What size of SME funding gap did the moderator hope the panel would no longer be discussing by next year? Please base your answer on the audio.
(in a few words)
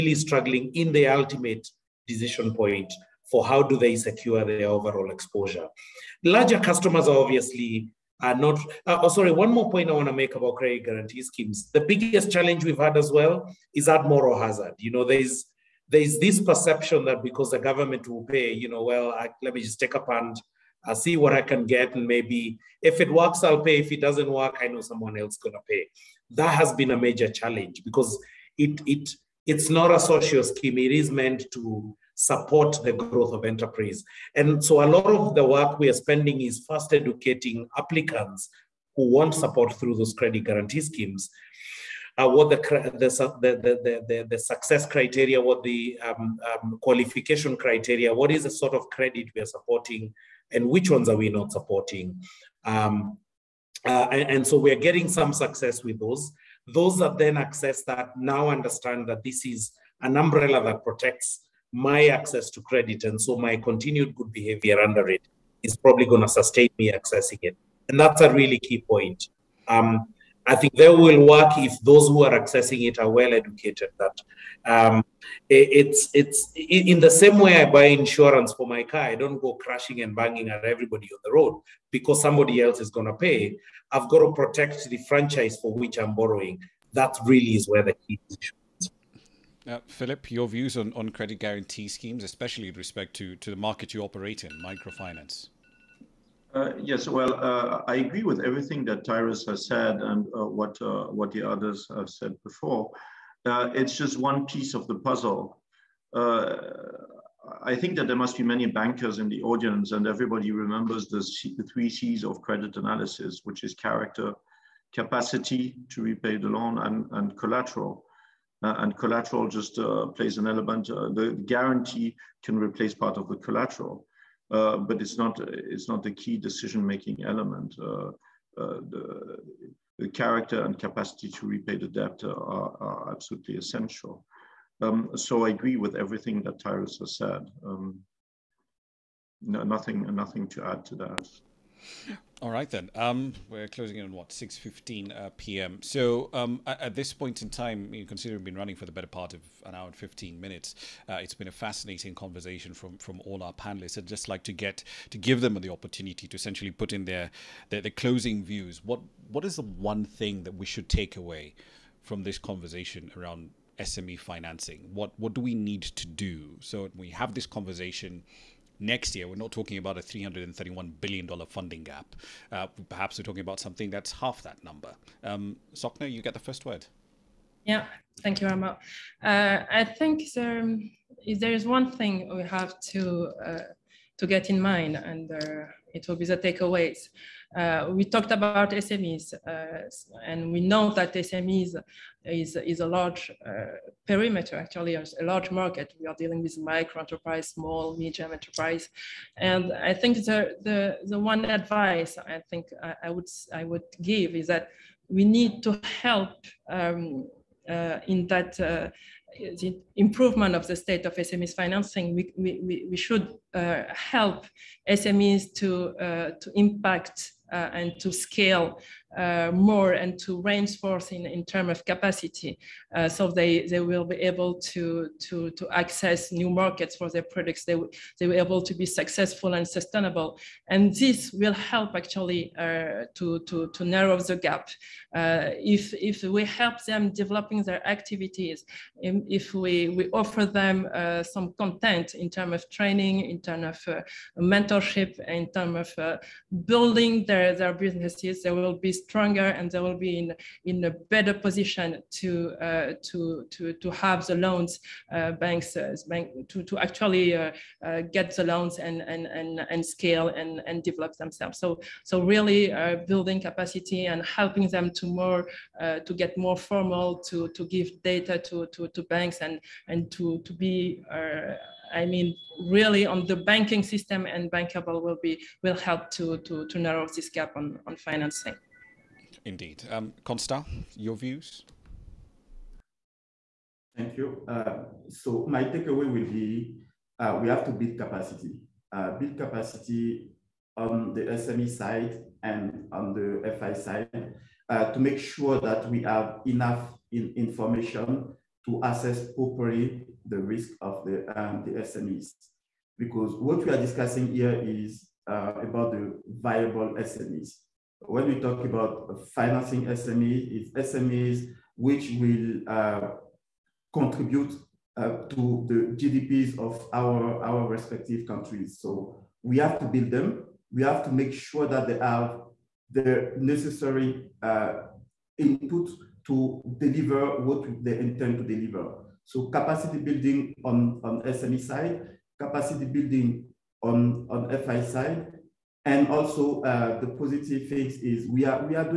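$331 billion.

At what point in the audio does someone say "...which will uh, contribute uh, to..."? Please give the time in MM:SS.
05:11.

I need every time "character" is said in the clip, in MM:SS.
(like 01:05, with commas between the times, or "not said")
01:53, 02:10.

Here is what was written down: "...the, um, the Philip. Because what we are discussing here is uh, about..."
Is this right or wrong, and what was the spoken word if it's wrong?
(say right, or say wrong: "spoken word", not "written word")
wrong: "SMEs", not "Philip".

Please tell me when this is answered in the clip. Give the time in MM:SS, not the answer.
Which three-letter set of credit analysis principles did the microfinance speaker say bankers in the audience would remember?
01:51.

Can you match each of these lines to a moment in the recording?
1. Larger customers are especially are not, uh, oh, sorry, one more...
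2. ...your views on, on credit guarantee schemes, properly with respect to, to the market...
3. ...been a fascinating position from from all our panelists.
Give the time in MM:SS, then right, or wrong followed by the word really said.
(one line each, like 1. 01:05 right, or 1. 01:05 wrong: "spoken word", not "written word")
1. 00:06 wrong: "obviously", not "especially"
2. 01:30 wrong: "especially", not "properly"
3. 02:31 wrong: "conversation", not "position".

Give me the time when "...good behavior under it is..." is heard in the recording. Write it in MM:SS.
01:04.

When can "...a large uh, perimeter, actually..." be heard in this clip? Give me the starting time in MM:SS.
03:12.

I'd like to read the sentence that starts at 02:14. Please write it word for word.
Um, so I agree with everything that Tyrus has said.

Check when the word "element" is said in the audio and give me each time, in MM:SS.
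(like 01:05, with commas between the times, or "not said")
02:00, 02:07.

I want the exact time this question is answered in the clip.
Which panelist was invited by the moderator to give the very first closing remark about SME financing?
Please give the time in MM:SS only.
02:55.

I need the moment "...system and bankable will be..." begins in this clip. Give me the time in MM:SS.
04:33.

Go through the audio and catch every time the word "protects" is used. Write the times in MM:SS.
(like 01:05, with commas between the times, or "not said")
01:00, 01:24.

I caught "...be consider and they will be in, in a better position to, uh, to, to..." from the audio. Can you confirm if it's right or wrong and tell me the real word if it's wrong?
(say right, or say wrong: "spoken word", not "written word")
wrong: "stronger", not "consider".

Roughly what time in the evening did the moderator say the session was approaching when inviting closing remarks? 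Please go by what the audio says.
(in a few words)
6:15 p.m.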